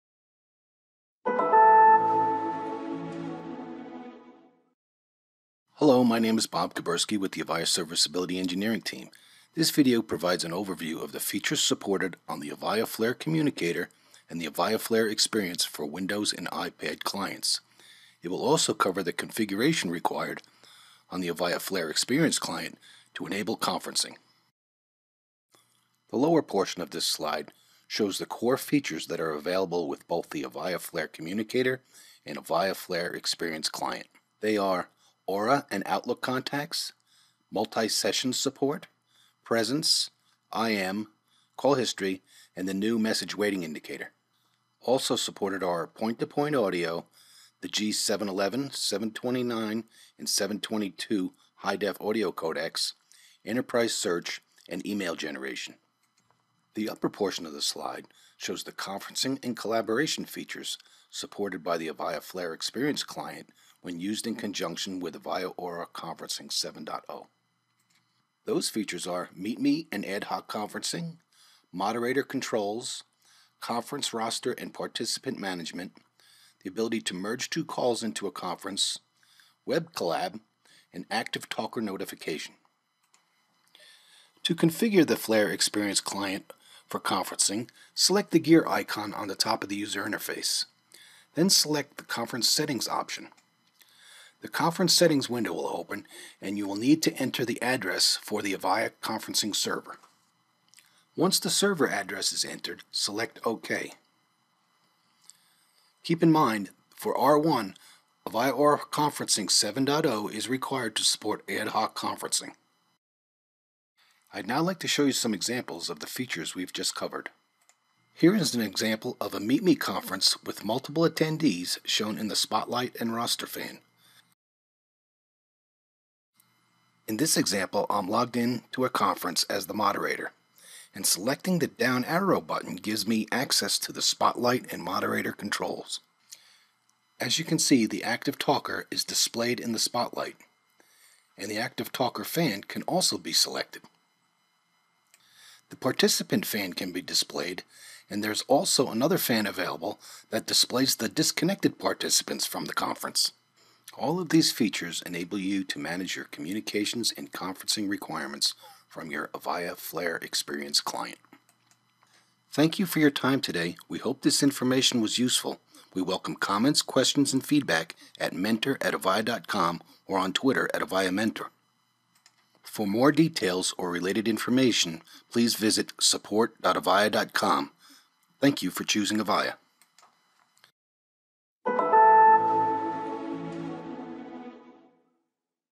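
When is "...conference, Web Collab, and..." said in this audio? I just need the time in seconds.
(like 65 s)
78 s.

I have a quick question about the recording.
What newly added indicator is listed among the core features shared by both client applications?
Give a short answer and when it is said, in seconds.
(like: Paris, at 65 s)
message waiting indicator, at 42 s.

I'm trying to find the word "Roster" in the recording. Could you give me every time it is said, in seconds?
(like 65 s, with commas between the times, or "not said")
74 s, 123 s.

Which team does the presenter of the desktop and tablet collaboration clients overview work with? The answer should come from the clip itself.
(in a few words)
Serviceability Engineering.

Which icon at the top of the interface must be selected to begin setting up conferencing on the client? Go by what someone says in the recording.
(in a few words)
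gear icon.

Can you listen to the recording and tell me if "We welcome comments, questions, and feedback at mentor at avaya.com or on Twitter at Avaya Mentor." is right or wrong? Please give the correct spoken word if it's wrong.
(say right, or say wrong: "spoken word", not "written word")
right.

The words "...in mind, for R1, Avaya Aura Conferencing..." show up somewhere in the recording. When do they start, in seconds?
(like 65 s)
106 s.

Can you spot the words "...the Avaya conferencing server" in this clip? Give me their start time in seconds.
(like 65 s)
98 s.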